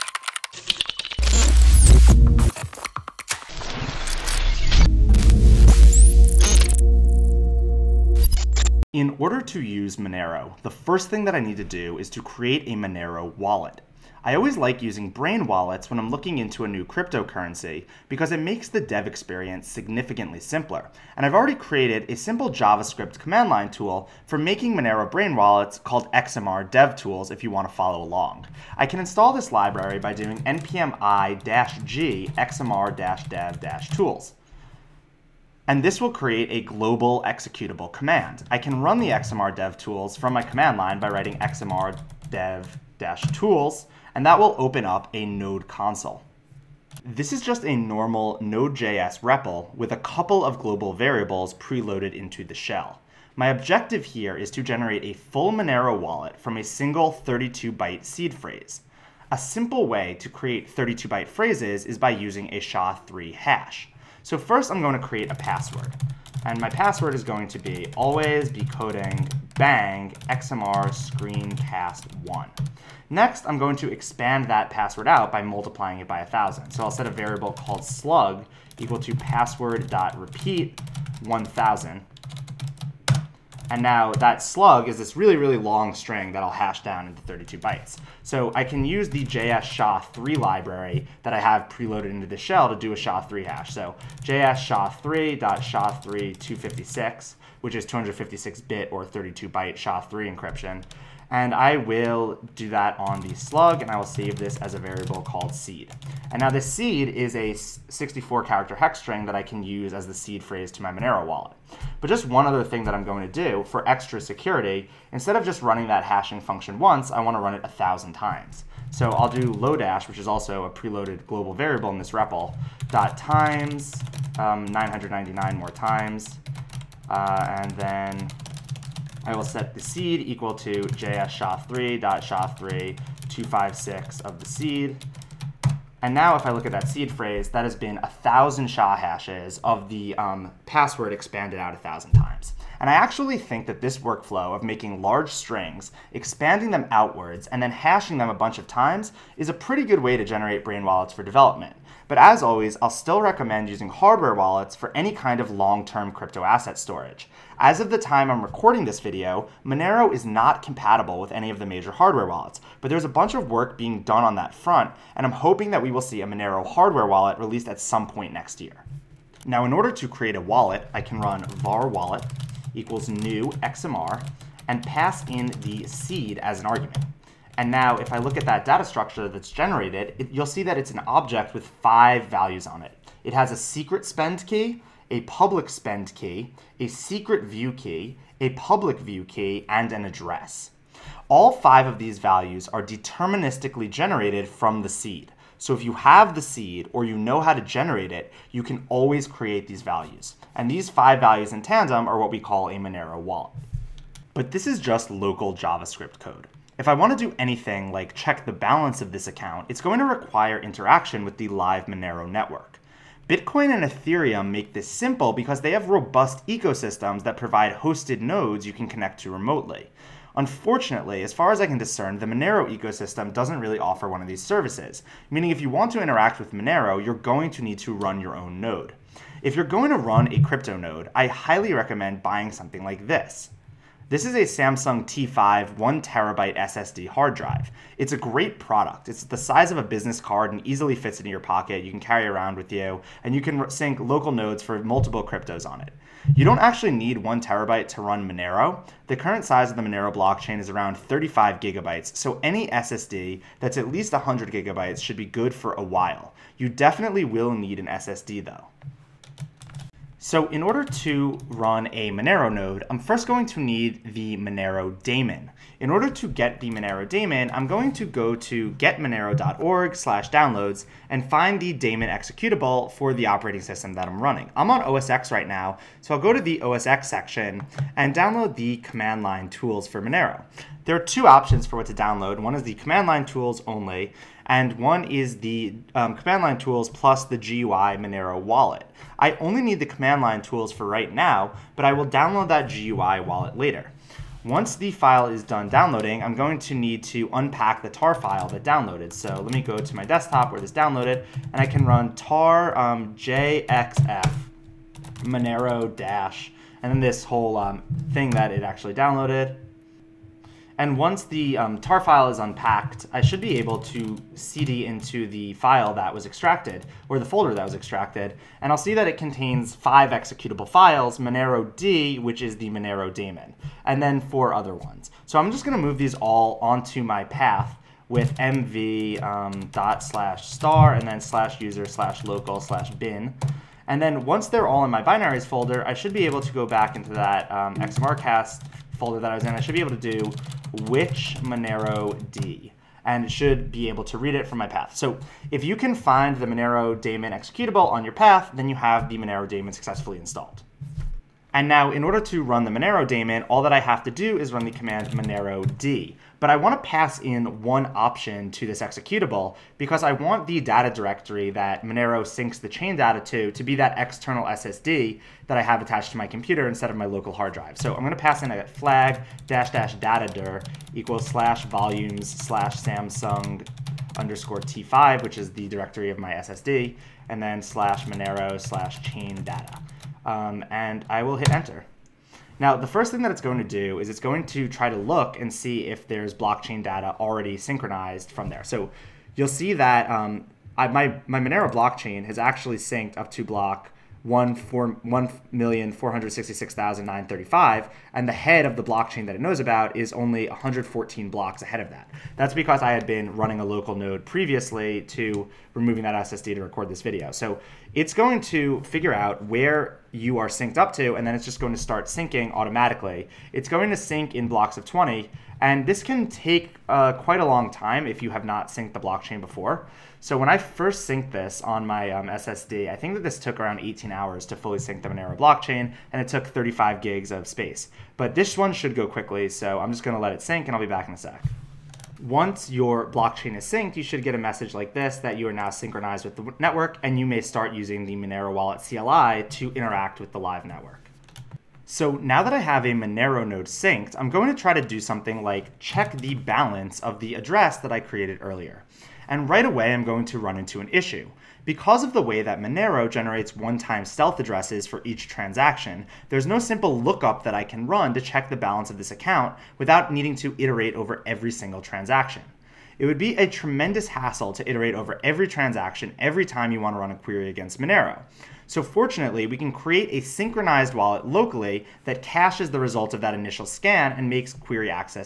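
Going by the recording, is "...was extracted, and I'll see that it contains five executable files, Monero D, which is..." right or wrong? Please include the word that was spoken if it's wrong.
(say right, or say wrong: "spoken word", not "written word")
right.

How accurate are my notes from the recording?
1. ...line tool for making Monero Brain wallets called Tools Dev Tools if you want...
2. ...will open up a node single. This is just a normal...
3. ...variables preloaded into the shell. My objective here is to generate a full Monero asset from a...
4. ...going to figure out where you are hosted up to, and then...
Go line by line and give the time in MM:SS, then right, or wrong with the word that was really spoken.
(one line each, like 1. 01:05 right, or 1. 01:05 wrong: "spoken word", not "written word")
1. 00:23 wrong: "XMR", not "Tools"
2. 00:44 wrong: "console", not "single"
3. 00:50 wrong: "wallet", not "asset"
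4. 06:48 wrong: "synced", not "hosted".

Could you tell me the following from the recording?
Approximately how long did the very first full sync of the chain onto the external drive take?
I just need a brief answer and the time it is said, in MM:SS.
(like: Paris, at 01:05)
18 hours, at 07:03.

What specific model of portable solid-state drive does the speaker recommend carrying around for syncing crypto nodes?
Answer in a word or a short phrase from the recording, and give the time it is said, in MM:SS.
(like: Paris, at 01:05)
Samsung T5, at 03:54.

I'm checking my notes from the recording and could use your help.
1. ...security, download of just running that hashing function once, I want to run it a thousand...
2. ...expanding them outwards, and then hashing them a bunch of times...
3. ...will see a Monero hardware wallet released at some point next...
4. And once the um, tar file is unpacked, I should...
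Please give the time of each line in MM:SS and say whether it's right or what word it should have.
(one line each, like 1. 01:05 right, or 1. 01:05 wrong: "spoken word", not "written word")
1. 01:54 wrong: "instead", not "download"
2. 02:26 right
3. 02:45 right
4. 05:10 right.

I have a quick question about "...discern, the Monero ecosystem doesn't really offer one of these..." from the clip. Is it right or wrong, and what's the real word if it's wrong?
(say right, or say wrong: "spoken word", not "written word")
right.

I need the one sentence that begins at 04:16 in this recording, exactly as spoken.
You definitely will need an SSD though.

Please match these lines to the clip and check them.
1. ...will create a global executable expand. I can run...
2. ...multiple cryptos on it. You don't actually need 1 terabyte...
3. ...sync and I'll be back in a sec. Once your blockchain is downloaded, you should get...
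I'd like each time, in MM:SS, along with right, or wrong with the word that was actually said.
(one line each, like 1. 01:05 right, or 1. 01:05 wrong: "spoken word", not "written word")
1. 00:36 wrong: "command", not "expand"
2. 04:04 right
3. 07:10 wrong: "synced", not "downloaded".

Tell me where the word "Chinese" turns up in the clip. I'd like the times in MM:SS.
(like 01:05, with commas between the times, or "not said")
not said.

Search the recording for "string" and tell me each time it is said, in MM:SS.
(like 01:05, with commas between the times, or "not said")
01:25, 01:48, 02:25.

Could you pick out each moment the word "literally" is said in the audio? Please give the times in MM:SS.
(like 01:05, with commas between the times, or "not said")
not said.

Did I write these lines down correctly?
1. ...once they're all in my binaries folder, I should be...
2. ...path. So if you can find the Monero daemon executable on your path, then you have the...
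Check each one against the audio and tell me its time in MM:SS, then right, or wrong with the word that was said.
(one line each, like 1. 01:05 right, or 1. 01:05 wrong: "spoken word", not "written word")
1. 05:34 right
2. 05:44 right.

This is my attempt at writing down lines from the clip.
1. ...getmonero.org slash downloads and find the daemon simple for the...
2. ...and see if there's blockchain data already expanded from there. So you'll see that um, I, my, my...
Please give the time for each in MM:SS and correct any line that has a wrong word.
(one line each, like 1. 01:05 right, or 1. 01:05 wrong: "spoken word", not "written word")
1. 04:28 wrong: "executable", not "simple"
2. 06:25 wrong: "synchronized", not "expanded".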